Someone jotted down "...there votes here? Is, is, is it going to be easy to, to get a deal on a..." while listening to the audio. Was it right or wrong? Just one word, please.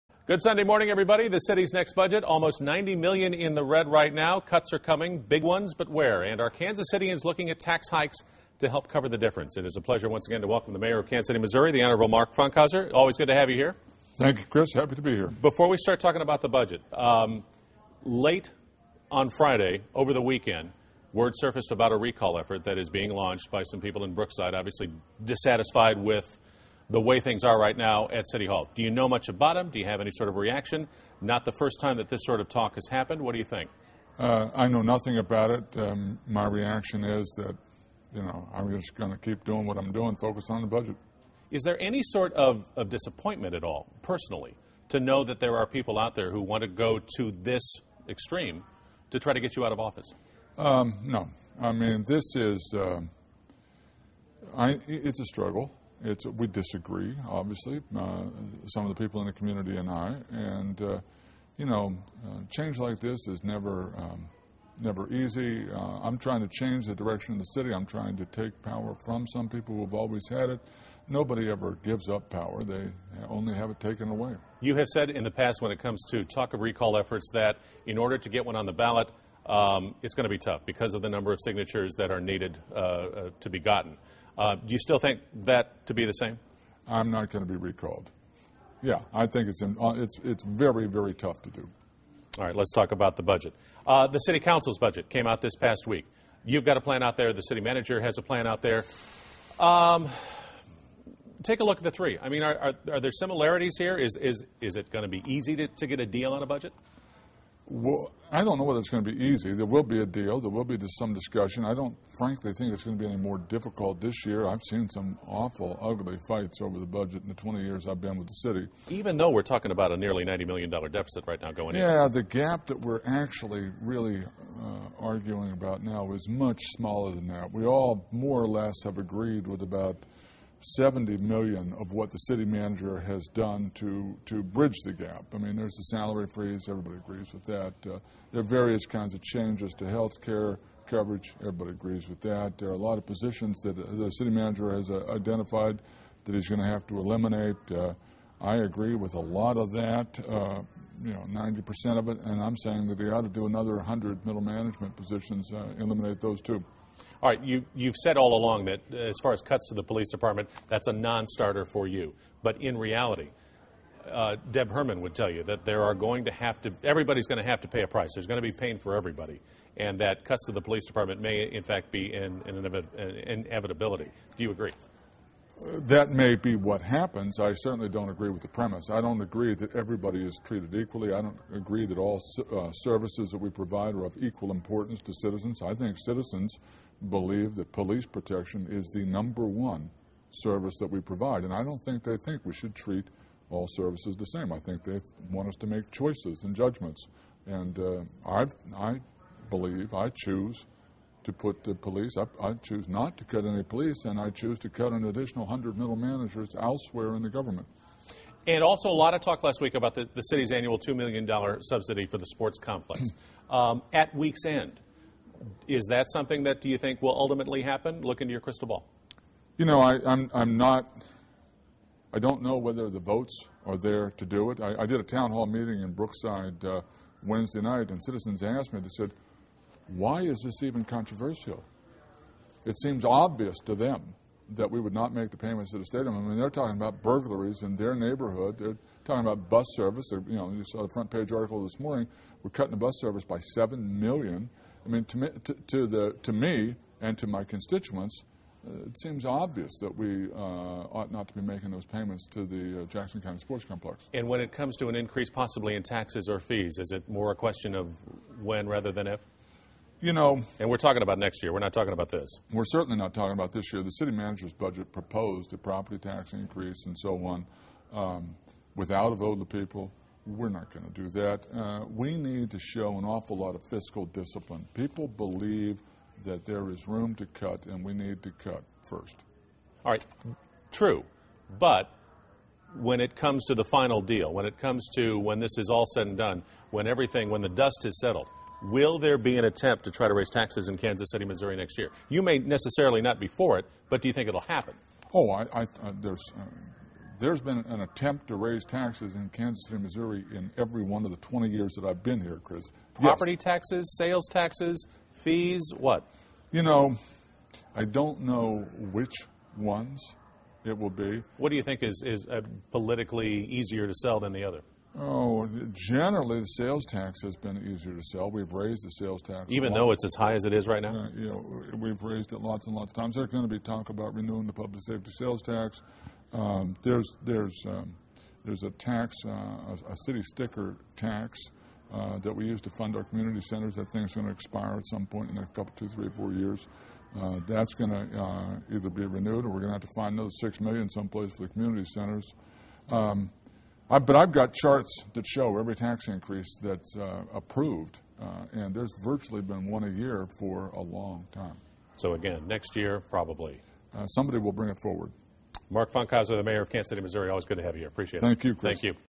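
wrong.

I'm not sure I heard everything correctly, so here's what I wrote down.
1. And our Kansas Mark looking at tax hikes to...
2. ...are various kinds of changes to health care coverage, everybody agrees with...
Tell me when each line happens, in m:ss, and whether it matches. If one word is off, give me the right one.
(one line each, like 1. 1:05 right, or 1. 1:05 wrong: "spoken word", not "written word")
1. 0:06 wrong: "Citians", not "Mark"
2. 2:18 right.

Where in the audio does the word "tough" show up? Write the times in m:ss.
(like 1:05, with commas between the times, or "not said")
1:20, 1:31.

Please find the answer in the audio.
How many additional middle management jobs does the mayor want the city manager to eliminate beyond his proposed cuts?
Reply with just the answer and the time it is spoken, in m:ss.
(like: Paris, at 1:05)
100, at 2:33.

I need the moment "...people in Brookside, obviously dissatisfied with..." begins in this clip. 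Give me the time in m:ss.
0:23.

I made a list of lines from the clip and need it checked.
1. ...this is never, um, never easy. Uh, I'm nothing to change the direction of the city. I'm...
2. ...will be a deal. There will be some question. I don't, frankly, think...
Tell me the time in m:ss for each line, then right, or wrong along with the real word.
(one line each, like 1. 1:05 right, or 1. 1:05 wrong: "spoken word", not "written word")
1. 1:02 wrong: "trying", not "nothing"
2. 1:49 wrong: "discussion", not "question".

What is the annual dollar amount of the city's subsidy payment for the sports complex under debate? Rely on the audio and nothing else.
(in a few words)
$2 million.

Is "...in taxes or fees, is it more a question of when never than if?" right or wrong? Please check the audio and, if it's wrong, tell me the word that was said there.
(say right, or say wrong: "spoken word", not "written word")
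wrong: "rather", not "never".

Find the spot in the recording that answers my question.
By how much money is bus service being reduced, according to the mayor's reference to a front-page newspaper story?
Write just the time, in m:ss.
4:03.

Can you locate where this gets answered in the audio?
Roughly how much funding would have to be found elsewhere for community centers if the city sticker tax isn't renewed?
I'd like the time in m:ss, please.
5:40.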